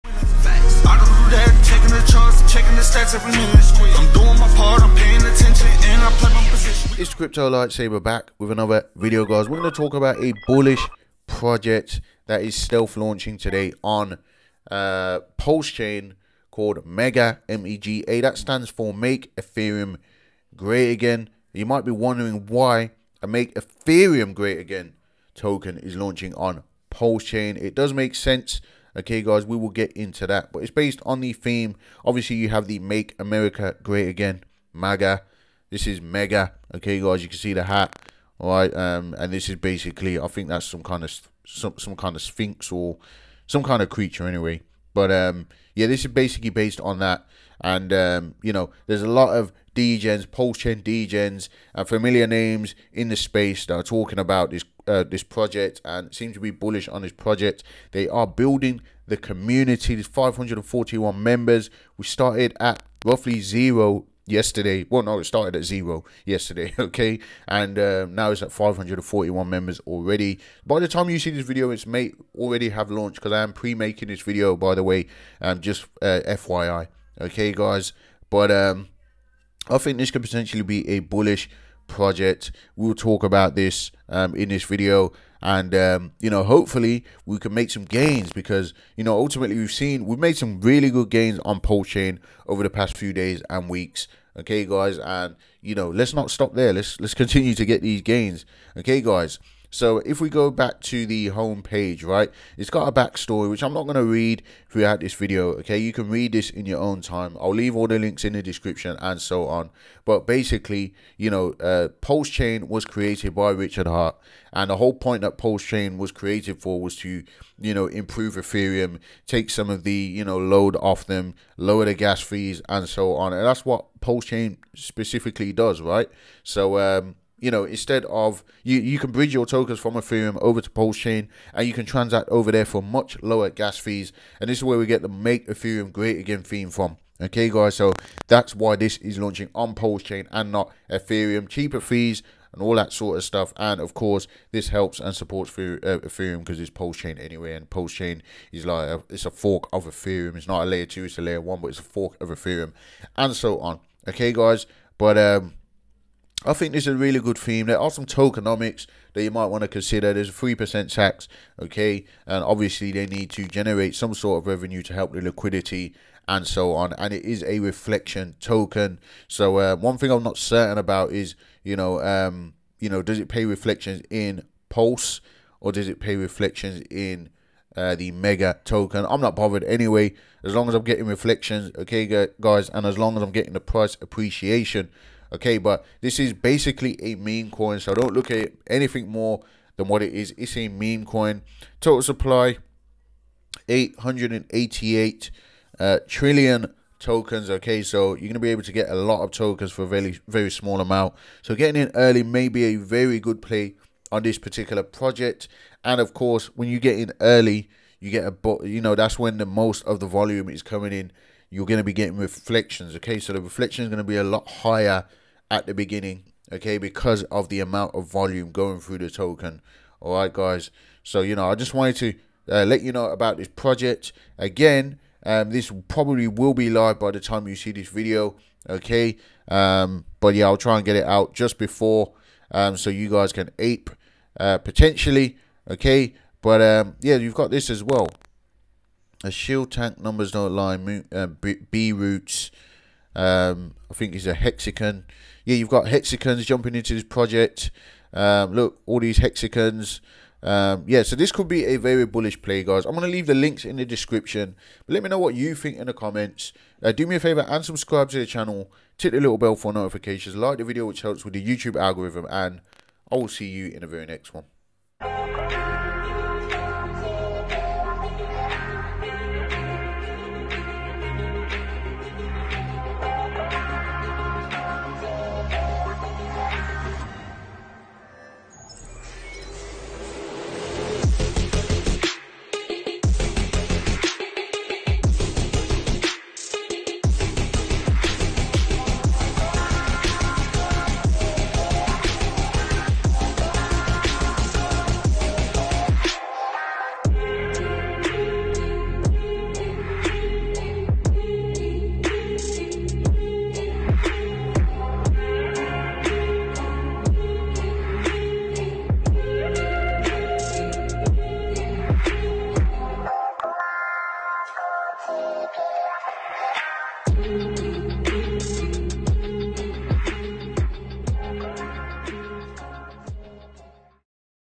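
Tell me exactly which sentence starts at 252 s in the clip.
I'm going to leave the links in the description.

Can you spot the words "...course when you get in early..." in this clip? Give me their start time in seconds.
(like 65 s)
206 s.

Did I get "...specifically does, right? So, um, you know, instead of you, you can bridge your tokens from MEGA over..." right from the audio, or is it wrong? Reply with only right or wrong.
wrong.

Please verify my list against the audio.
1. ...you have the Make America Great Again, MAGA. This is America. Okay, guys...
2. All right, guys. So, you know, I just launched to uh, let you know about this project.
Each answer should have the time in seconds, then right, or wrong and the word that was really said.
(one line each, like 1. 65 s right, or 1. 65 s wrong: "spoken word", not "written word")
1. 32 s wrong: "Mega", not "America"
2. 219 s wrong: "wanted", not "launched".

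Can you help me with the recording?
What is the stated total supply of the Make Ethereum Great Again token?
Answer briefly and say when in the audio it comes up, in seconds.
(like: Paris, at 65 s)
888 trillion, at 193 s.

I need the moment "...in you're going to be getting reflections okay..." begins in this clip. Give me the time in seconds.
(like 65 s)
210 s.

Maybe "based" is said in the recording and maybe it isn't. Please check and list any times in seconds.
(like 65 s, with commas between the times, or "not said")
30 s, 46 s.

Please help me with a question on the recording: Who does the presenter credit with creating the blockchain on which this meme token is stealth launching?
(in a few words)
Richard Heart.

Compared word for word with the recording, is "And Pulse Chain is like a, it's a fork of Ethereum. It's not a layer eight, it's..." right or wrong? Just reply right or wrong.
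wrong.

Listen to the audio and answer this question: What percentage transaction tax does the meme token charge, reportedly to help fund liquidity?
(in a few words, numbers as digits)
3%.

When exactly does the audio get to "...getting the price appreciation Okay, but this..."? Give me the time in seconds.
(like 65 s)
183 s.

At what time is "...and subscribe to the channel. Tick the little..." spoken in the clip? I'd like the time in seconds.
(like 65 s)
257 s.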